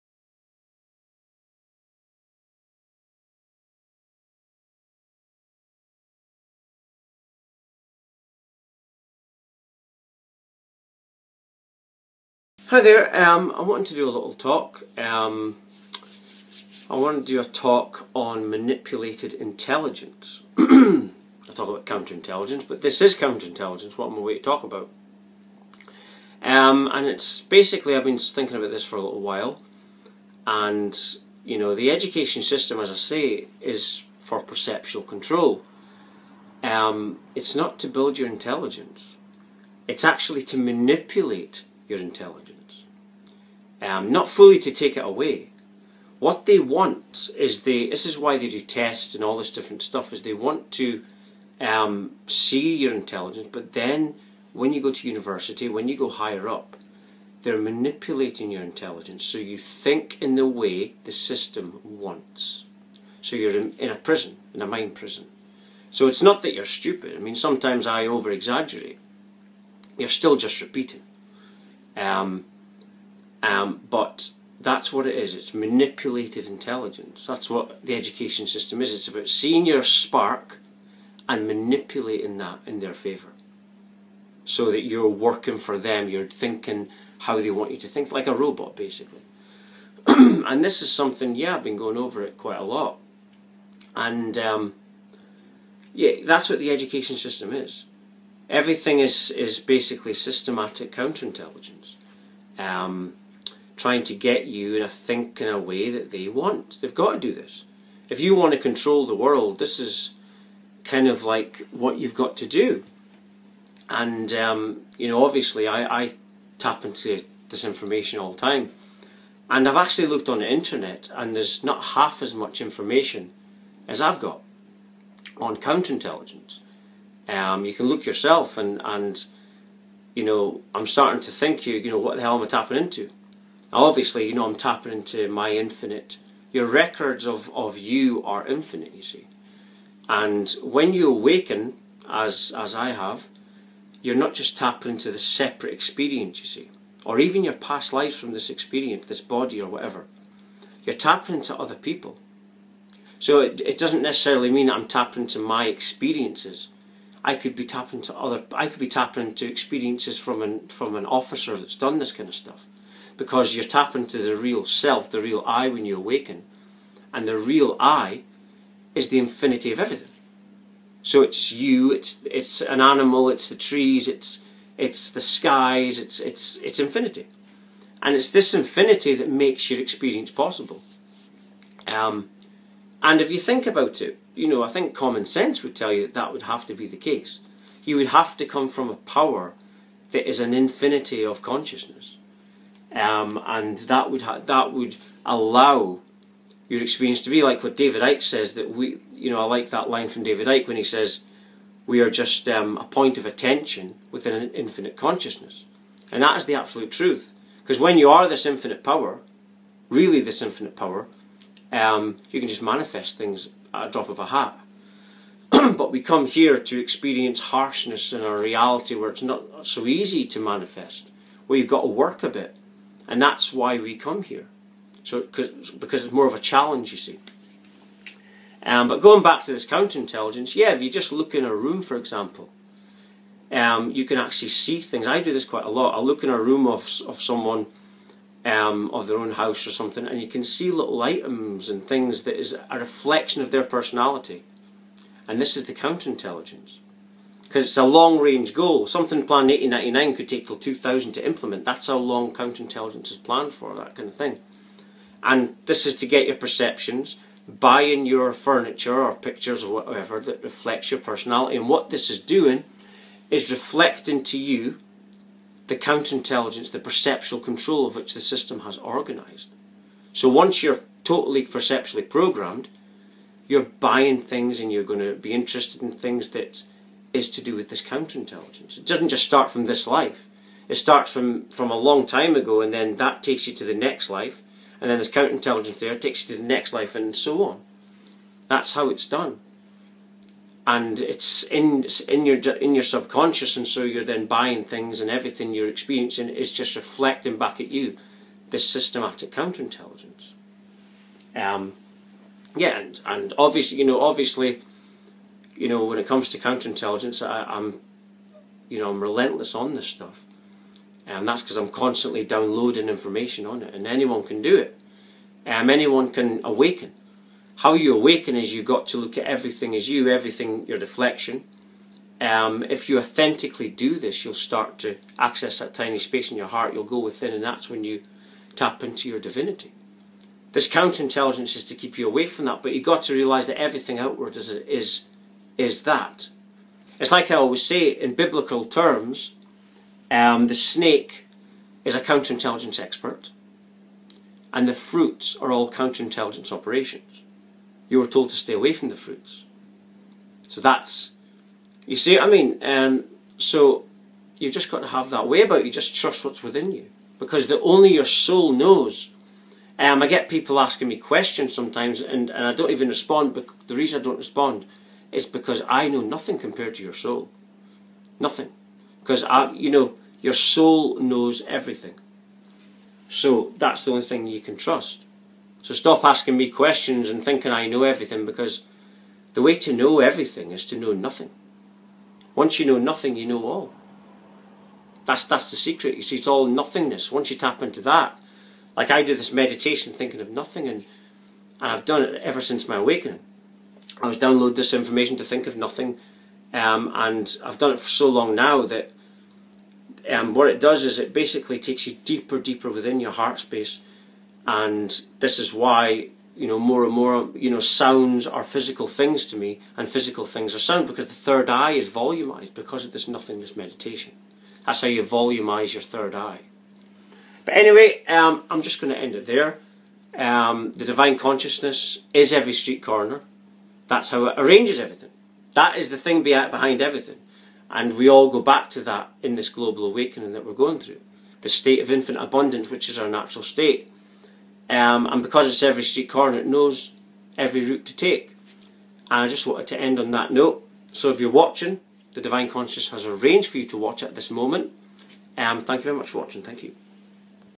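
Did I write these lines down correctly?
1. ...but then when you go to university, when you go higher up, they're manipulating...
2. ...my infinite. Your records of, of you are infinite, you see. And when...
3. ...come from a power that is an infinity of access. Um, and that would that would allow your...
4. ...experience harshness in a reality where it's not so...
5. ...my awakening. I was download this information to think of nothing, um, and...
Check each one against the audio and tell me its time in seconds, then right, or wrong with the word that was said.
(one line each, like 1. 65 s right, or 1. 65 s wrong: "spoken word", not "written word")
1. 53 s right
2. 135 s right
3. 188 s wrong: "consciousness", not "access"
4. 216 s right
5. 392 s right.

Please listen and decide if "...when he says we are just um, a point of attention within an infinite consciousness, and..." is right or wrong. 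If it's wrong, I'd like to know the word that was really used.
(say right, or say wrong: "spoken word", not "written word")
right.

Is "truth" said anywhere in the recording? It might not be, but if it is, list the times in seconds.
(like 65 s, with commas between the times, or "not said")
206 s.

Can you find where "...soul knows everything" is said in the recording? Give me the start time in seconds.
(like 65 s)
370 s.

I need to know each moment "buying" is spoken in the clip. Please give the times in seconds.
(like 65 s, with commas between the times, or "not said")
257 s, 273 s, 294 s.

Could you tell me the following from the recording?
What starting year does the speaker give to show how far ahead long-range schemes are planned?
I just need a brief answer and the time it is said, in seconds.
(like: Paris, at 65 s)
1899, at 249 s.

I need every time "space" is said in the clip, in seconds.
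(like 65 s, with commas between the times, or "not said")
325 s, 403 s.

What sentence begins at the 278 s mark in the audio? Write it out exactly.
It doesn't just start from this life.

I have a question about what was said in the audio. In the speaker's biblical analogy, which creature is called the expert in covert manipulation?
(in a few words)
the snake.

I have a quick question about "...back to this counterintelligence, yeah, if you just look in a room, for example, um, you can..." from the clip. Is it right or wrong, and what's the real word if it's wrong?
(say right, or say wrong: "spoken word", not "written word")
right.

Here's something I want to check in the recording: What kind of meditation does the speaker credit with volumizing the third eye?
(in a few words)
nothingness meditation.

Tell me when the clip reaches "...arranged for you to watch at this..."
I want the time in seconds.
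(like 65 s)
443 s.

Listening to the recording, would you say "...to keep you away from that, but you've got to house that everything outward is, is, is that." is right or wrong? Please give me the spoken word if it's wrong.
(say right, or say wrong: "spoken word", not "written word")
wrong: "realise", not "house".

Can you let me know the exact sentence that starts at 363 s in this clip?
But the reason I don't respond is because I know nothing compared to your soul.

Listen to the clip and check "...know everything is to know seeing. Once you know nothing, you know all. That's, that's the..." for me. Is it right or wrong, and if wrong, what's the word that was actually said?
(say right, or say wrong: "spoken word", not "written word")
wrong: "nothing", not "seeing".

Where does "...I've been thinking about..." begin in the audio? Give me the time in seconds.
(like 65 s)
27 s.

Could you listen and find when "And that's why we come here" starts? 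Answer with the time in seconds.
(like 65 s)
223 s.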